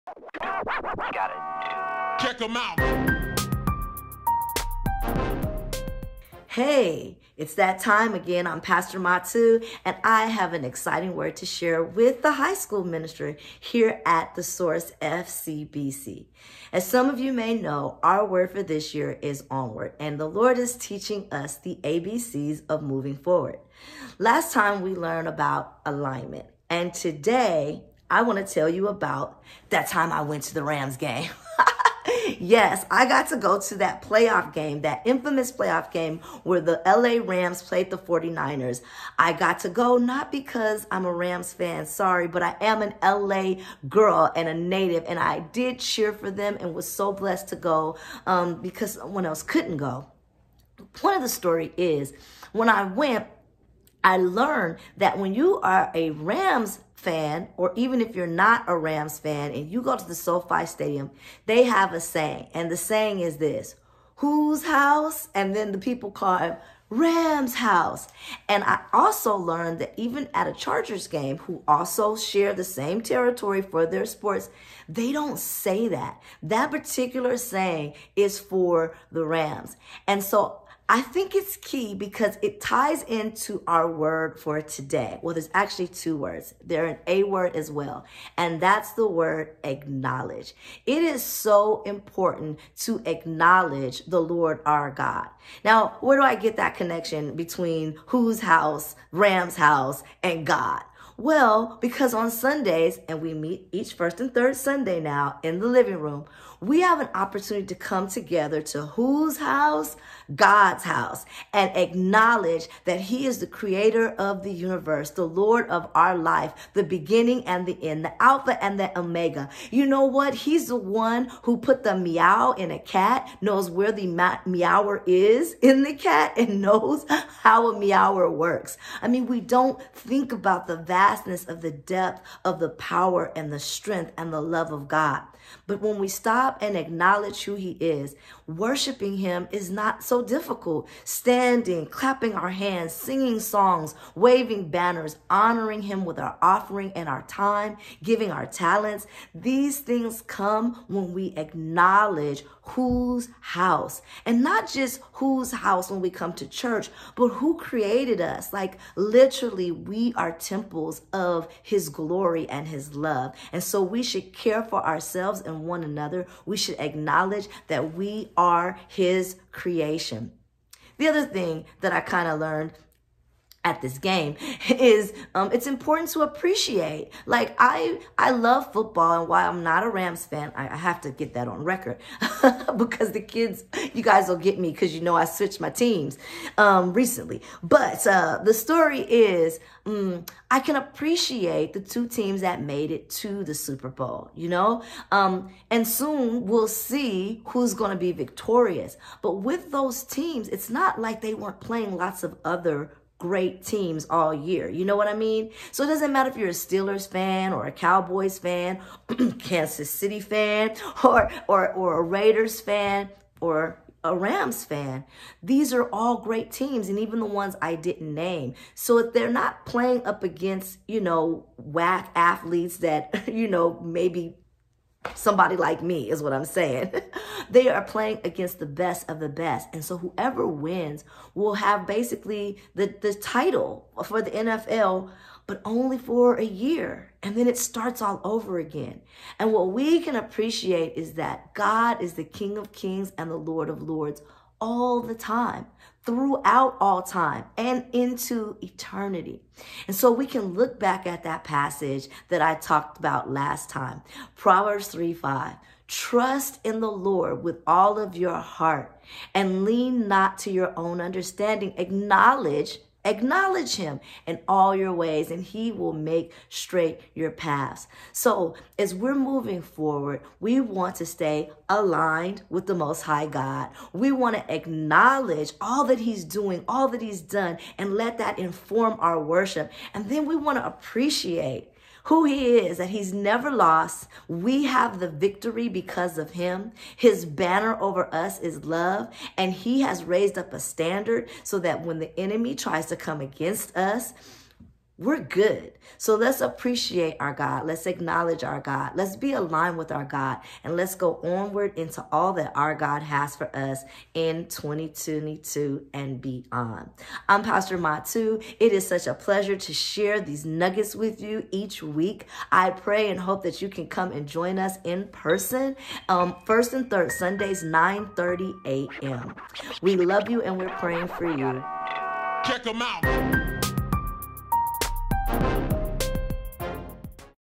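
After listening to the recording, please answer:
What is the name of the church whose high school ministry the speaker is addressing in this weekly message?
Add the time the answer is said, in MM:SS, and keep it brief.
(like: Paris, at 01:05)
The Source FCBC, at 00:14.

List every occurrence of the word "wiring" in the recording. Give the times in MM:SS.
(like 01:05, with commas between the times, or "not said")
not said.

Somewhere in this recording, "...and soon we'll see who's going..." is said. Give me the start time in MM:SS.
03:15.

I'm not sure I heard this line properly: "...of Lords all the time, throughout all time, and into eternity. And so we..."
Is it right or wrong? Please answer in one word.
right.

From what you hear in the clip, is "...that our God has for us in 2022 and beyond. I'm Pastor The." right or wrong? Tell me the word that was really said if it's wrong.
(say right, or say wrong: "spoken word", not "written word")
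wrong: "Matu", not "The".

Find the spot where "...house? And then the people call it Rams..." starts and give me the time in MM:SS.
01:04.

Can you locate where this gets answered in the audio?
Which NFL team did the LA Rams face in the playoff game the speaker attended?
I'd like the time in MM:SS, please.
00:37.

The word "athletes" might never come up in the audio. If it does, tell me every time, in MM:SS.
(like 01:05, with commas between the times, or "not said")
03:42.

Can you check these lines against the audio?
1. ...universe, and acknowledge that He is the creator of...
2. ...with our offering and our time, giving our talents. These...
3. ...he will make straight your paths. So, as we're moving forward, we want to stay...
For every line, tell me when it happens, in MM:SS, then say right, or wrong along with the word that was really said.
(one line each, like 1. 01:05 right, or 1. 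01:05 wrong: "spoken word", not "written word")
1. 01:50 wrong: "house", not "universe"
2. 02:26 right
3. 04:25 right.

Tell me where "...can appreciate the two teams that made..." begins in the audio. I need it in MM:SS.
03:10.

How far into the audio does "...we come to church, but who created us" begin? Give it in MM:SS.
02:36.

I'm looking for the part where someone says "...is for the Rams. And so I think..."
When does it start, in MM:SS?
01:18.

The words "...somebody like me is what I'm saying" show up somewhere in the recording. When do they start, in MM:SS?
03:45.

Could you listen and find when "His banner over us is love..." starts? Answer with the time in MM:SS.
04:46.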